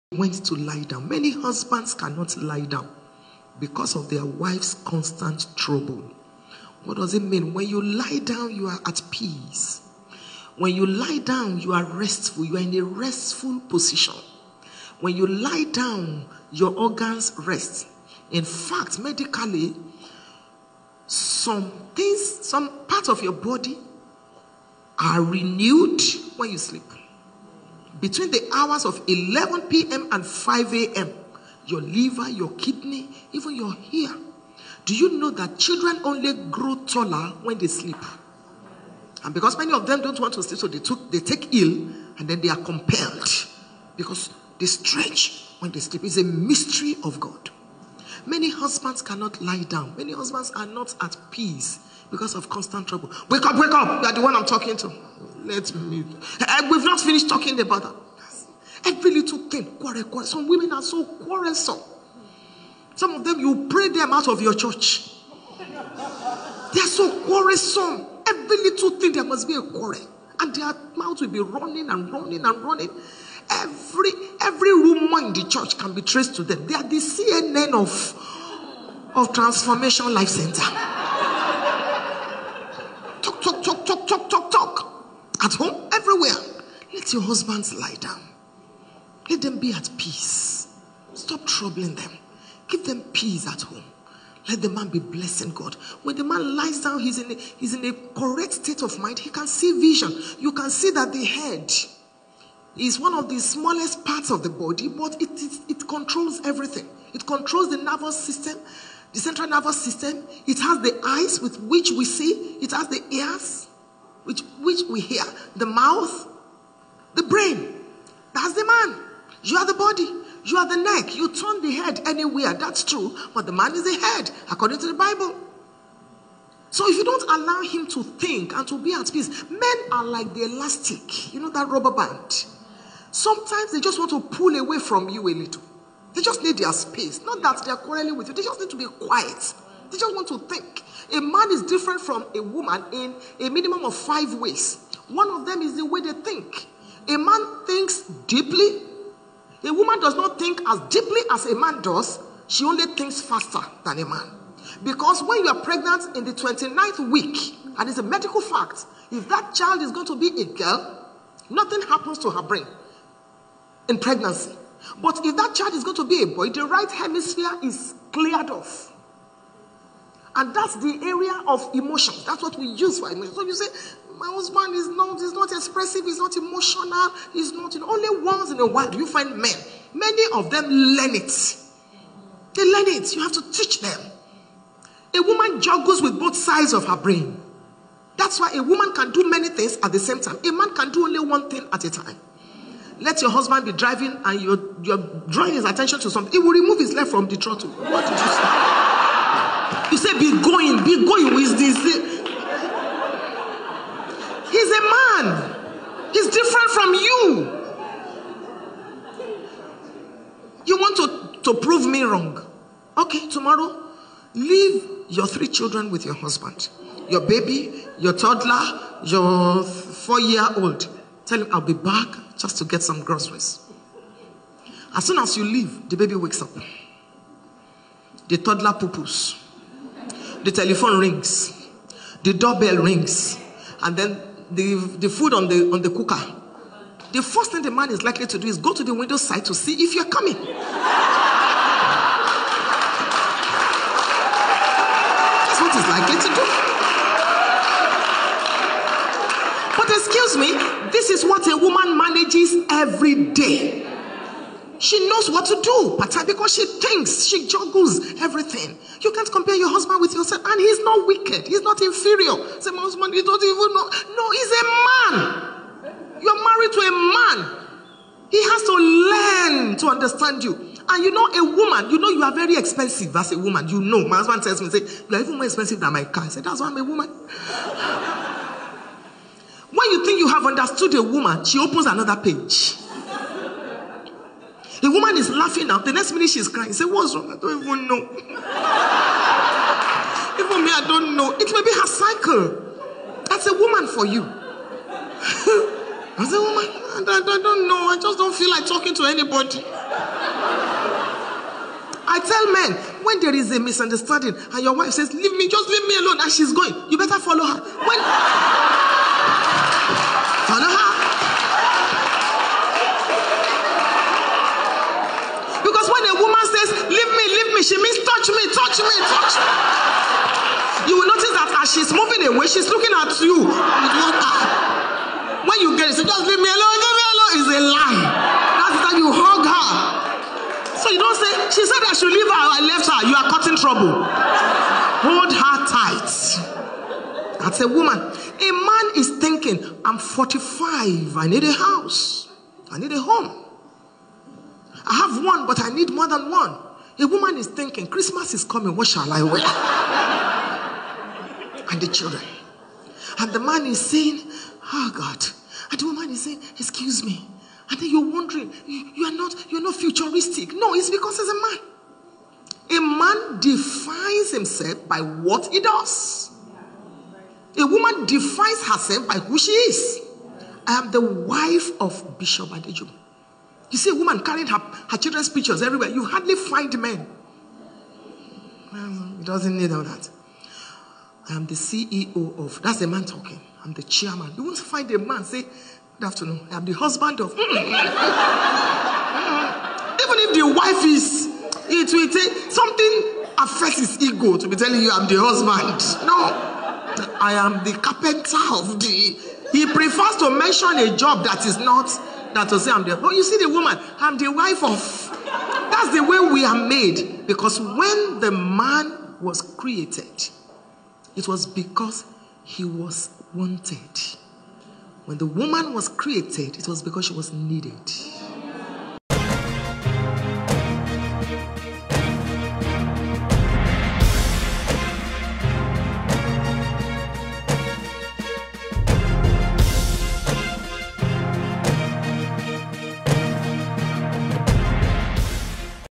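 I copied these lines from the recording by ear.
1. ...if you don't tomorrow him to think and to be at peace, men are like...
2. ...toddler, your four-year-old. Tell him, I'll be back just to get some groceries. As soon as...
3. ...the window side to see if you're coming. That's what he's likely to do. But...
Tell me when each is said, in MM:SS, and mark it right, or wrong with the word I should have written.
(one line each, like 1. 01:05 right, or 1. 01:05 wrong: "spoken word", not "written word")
1. 02:06 wrong: "allow", not "tomorrow"
2. 03:38 right
3. 03:58 right.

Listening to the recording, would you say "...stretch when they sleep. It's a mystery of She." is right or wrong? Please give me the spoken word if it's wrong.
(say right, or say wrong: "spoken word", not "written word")
wrong: "God", not "She".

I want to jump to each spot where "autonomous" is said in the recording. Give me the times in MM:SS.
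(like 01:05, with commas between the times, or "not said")
not said.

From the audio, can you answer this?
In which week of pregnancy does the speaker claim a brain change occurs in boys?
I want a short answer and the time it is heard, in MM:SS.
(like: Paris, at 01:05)
29th week, at 02:36.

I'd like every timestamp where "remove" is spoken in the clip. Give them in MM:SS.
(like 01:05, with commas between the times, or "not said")
03:16.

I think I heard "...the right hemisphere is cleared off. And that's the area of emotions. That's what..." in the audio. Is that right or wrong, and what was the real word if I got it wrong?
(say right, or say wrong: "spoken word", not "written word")
right.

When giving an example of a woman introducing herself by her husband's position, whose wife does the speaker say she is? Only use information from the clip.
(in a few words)
Bishop Adejumo.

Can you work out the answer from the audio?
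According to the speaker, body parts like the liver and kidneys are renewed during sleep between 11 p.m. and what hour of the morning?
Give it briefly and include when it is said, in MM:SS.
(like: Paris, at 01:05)
5 a.m., at 00:30.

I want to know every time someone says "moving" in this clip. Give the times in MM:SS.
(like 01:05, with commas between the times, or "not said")
05:21.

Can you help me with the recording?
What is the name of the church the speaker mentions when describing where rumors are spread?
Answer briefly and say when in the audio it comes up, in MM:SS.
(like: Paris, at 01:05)
Transformation Life Center, at 01:19.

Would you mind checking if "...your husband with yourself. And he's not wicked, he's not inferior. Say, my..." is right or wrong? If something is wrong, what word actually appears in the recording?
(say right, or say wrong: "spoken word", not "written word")
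right.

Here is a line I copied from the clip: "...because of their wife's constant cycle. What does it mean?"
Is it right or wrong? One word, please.
wrong.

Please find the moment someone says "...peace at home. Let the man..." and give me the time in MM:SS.
01:33.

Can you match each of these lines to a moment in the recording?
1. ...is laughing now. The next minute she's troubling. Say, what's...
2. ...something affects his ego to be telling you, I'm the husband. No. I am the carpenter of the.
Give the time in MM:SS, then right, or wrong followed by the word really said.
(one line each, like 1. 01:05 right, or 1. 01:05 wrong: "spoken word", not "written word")
1. 04:45 wrong: "crying", not "troubling"
2. 06:32 right.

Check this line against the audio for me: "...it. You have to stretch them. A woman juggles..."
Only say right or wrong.
wrong.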